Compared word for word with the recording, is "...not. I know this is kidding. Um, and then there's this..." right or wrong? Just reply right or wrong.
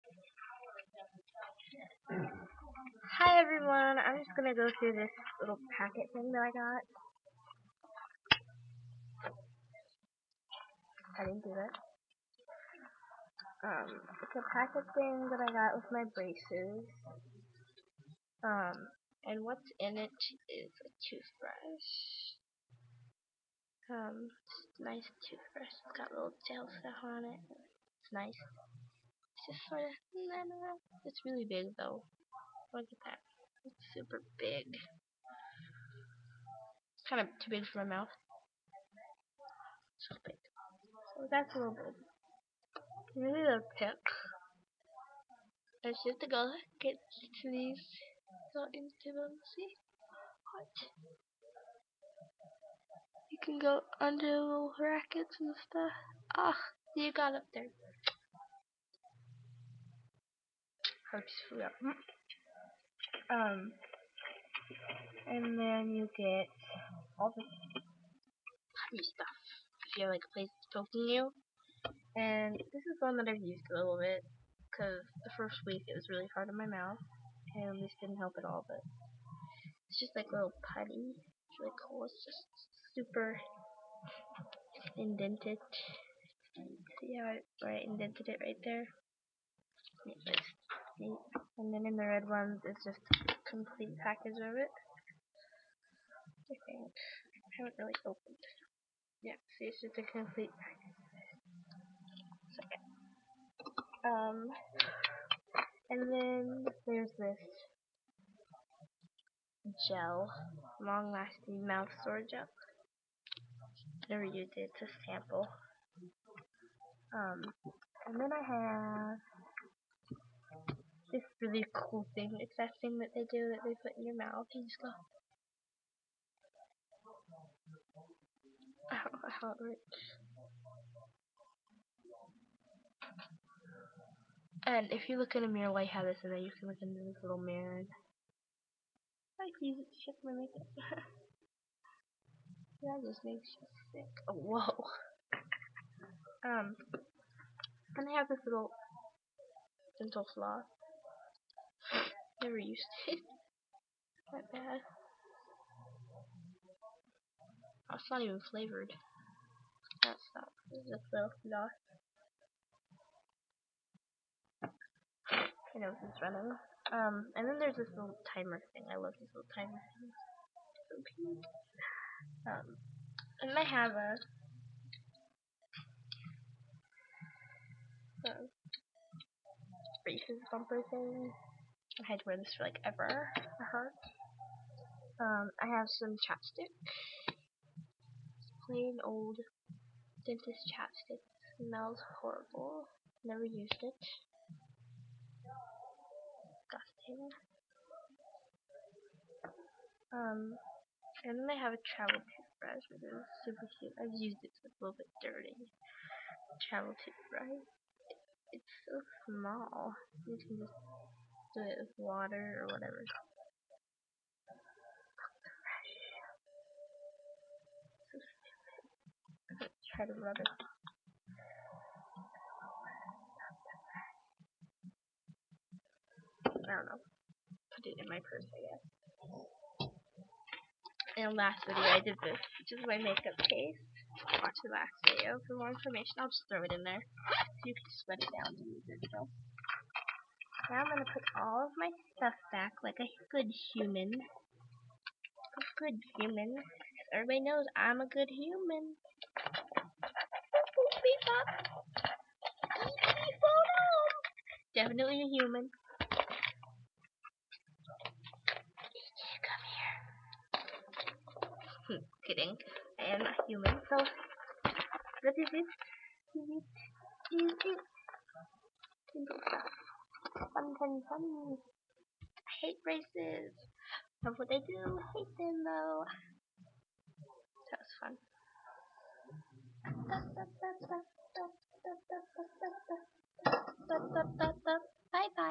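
wrong.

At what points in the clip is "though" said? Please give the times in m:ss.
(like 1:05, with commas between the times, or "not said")
0:31, 2:41, 4:35.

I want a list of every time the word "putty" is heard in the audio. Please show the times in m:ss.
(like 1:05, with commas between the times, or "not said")
1:07, 1:20.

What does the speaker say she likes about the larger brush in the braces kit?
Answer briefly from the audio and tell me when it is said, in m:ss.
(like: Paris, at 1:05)
gel stuff, at 0:26.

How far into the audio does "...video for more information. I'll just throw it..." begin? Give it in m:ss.
3:55.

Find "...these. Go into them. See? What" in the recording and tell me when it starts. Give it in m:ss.
0:47.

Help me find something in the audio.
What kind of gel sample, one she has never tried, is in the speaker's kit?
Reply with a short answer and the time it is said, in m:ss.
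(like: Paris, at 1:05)
long-lasting mouth sore gel, at 1:50.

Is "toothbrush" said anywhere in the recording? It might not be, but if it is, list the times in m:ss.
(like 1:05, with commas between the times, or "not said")
0:21, 0:25, 3:22, 3:27.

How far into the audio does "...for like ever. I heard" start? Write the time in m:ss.
3:02.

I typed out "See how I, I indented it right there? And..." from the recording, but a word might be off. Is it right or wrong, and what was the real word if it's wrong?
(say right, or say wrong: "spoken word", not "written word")
right.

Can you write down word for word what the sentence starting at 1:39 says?
Yeah, see, it's just a complete package.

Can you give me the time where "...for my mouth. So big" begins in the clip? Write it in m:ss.
0:37.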